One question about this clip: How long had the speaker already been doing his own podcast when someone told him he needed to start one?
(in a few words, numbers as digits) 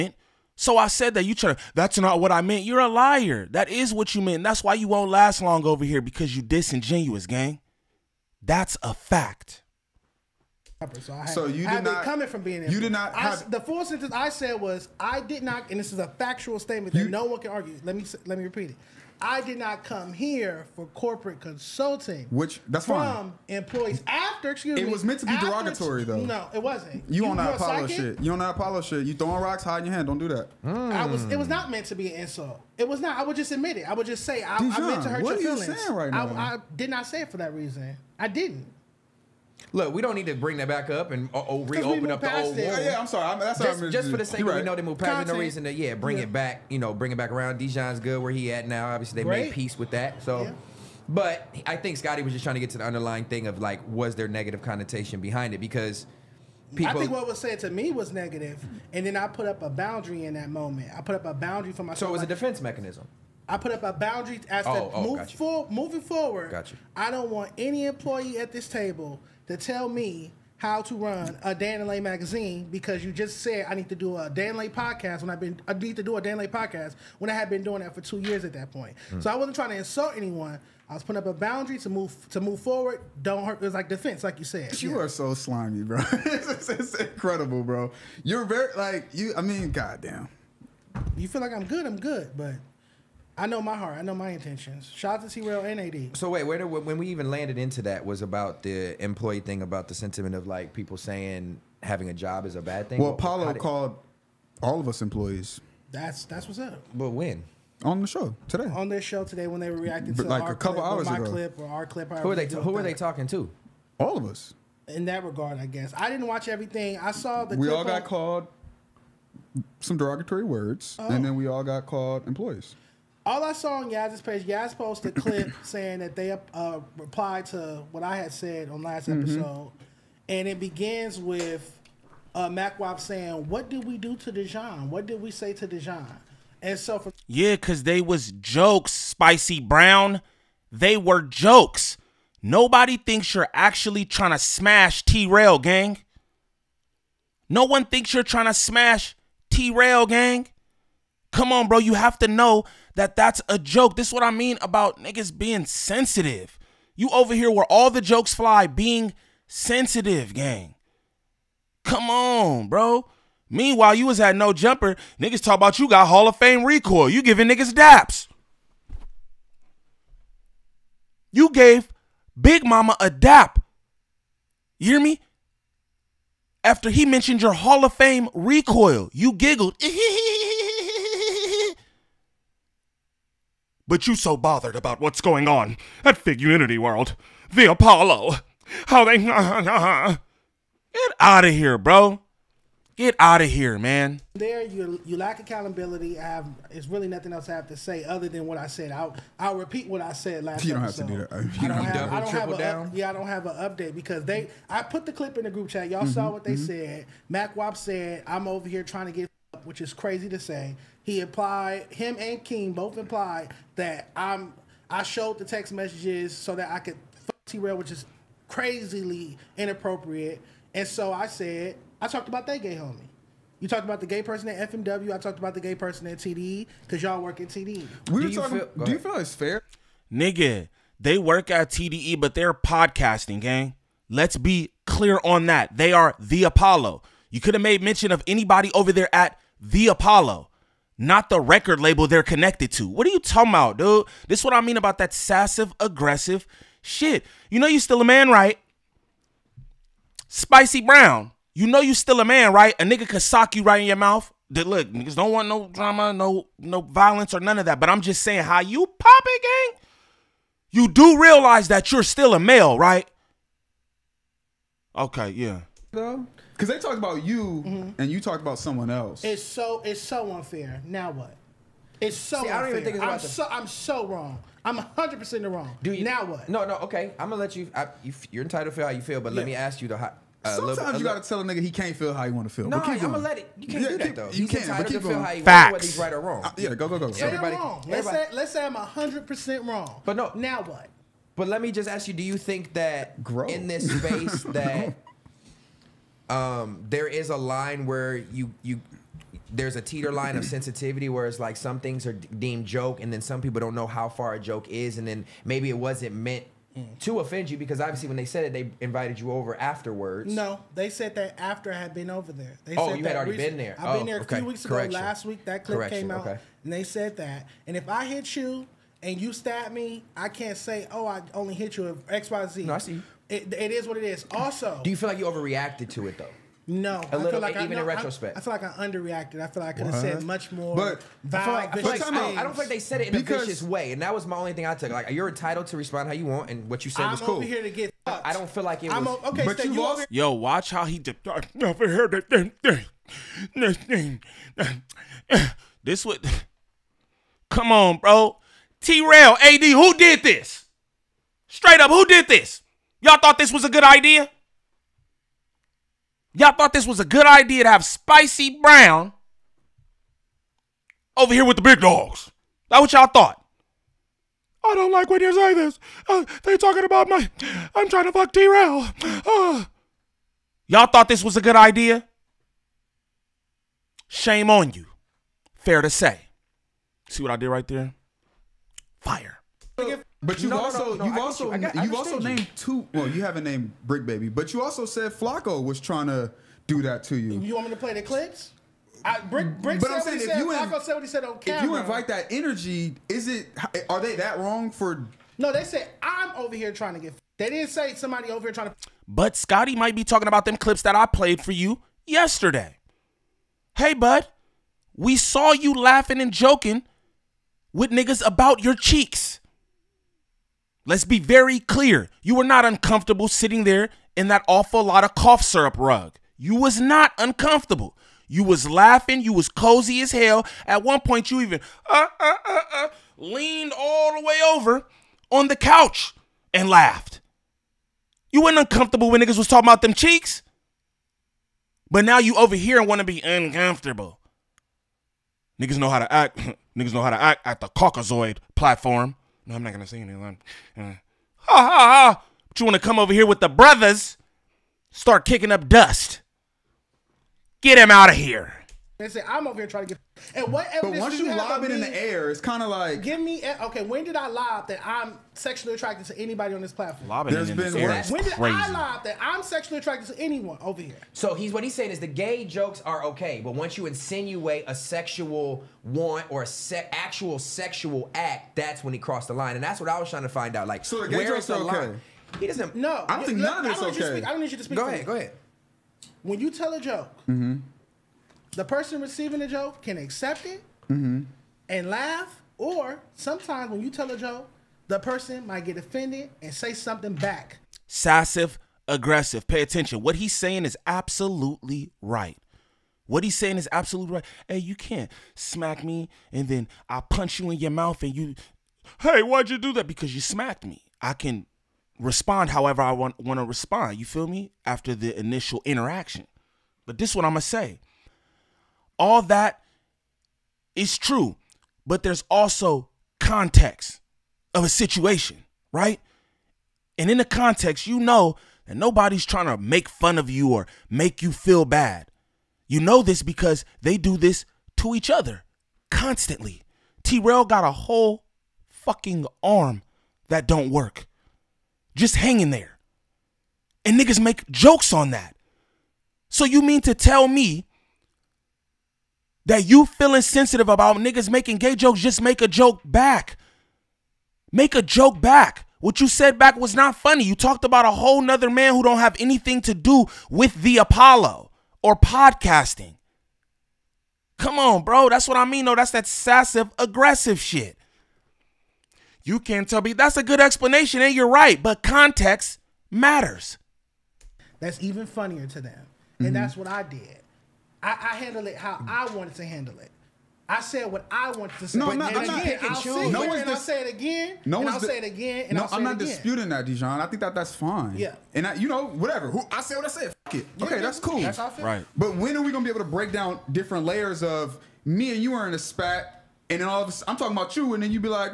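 two years.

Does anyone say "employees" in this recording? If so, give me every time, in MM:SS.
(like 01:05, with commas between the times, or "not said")
00:23, 01:07, 01:39, 01:45, 02:02.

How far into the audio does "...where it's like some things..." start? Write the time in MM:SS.
05:01.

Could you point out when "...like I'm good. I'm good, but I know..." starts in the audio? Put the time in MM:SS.
01:31.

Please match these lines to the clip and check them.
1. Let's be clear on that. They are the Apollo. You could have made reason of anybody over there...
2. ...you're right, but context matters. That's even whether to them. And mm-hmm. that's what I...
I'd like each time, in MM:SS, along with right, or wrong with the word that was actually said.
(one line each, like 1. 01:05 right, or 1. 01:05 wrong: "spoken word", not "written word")
1. 03:54 wrong: "mention", not "reason"
2. 09:21 wrong: "funnier", not "whether".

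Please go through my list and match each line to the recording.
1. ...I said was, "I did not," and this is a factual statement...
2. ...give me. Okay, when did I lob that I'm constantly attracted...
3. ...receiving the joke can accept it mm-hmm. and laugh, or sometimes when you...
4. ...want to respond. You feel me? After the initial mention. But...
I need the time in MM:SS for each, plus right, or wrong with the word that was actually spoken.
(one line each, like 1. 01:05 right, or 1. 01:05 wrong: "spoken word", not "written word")
1. 00:14 right
2. 07:33 wrong: "sexually", not "constantly"
3. 07:59 right
4. 08:23 wrong: "interaction", not "mention".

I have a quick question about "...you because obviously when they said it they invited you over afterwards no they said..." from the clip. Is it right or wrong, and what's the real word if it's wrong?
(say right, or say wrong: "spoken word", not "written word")
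right.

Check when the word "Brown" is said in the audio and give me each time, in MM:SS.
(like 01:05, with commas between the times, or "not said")
02:19, 04:10, 05:58.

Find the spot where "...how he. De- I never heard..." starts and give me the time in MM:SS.
05:40.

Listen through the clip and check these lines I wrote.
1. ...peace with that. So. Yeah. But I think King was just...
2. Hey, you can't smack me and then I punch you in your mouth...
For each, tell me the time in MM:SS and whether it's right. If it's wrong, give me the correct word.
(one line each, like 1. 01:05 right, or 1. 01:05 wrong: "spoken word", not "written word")
1. 00:49 wrong: "Scotty", not "King"
2. 08:14 right.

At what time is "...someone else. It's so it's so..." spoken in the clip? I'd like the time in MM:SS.
04:28.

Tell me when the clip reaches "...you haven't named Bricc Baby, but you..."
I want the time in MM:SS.
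06:23.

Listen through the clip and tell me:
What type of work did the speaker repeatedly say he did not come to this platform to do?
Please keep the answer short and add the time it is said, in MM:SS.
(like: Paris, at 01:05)
corporate consulting, at 00:20.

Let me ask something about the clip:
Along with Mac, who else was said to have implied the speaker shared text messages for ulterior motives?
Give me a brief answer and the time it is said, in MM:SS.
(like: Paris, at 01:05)
King, at 03:32.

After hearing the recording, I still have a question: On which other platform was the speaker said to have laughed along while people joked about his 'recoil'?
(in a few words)
No Jumper.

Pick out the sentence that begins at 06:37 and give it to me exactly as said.
They didn't say somebody over here trying to.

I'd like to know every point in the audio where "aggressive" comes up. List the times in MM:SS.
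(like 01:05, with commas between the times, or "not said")
04:05, 08:08, 09:16.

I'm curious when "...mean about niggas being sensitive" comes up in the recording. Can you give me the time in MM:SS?
02:34.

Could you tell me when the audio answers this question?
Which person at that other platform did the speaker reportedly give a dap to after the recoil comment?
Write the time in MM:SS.
02:52.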